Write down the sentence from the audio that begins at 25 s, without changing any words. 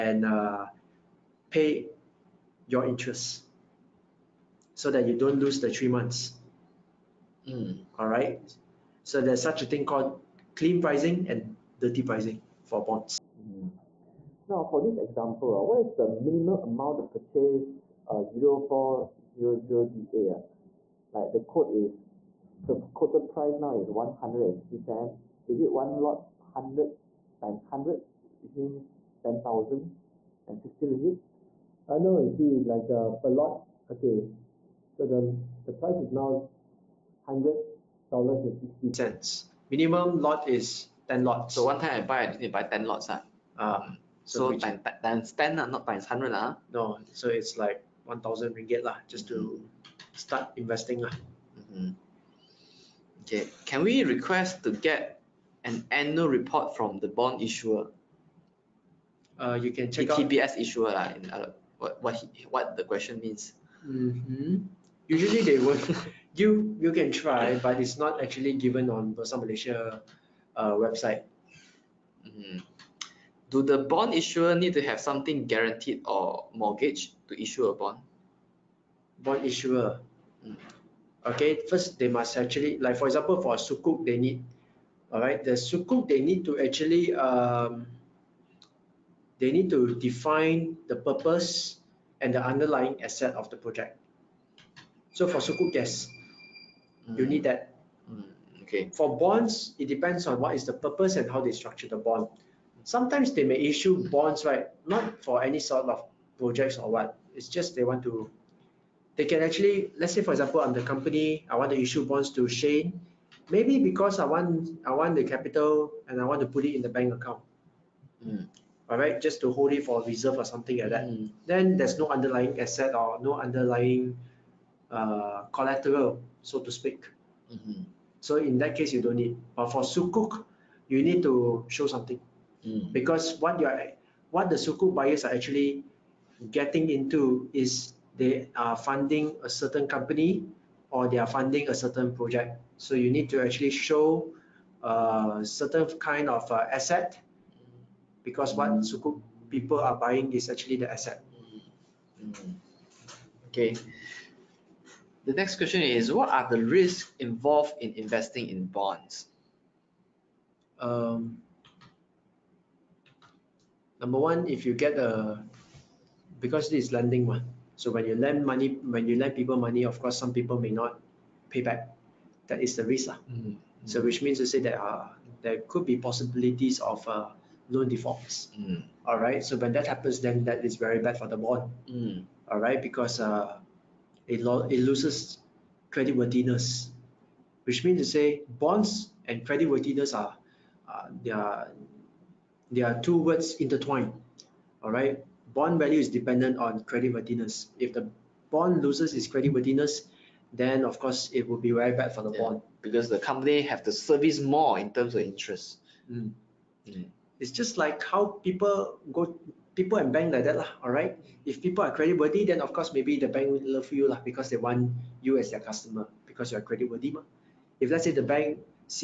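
Is it one lot 100 times 100, which means ten thousand and sixty ringgit?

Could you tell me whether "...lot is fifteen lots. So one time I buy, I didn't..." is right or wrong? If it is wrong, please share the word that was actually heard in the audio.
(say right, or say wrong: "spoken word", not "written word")
wrong: "ten", not "fifteen".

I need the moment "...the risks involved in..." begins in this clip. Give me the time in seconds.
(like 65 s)
156 s.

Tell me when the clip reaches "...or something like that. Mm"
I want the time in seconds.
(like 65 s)
120 s.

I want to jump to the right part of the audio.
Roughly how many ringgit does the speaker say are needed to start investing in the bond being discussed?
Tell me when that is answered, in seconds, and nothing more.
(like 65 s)
48 s.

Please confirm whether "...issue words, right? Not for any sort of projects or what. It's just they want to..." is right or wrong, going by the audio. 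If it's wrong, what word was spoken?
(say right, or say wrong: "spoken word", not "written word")
wrong: "bonds", not "words".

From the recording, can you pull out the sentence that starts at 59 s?
Uh, you can check the TBS issuer lah.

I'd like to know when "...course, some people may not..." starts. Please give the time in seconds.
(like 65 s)
169 s.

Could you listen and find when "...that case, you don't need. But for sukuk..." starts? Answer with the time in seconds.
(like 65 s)
128 s.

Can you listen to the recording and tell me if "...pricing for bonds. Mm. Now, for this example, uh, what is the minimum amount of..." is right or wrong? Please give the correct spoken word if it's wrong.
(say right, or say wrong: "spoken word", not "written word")
right.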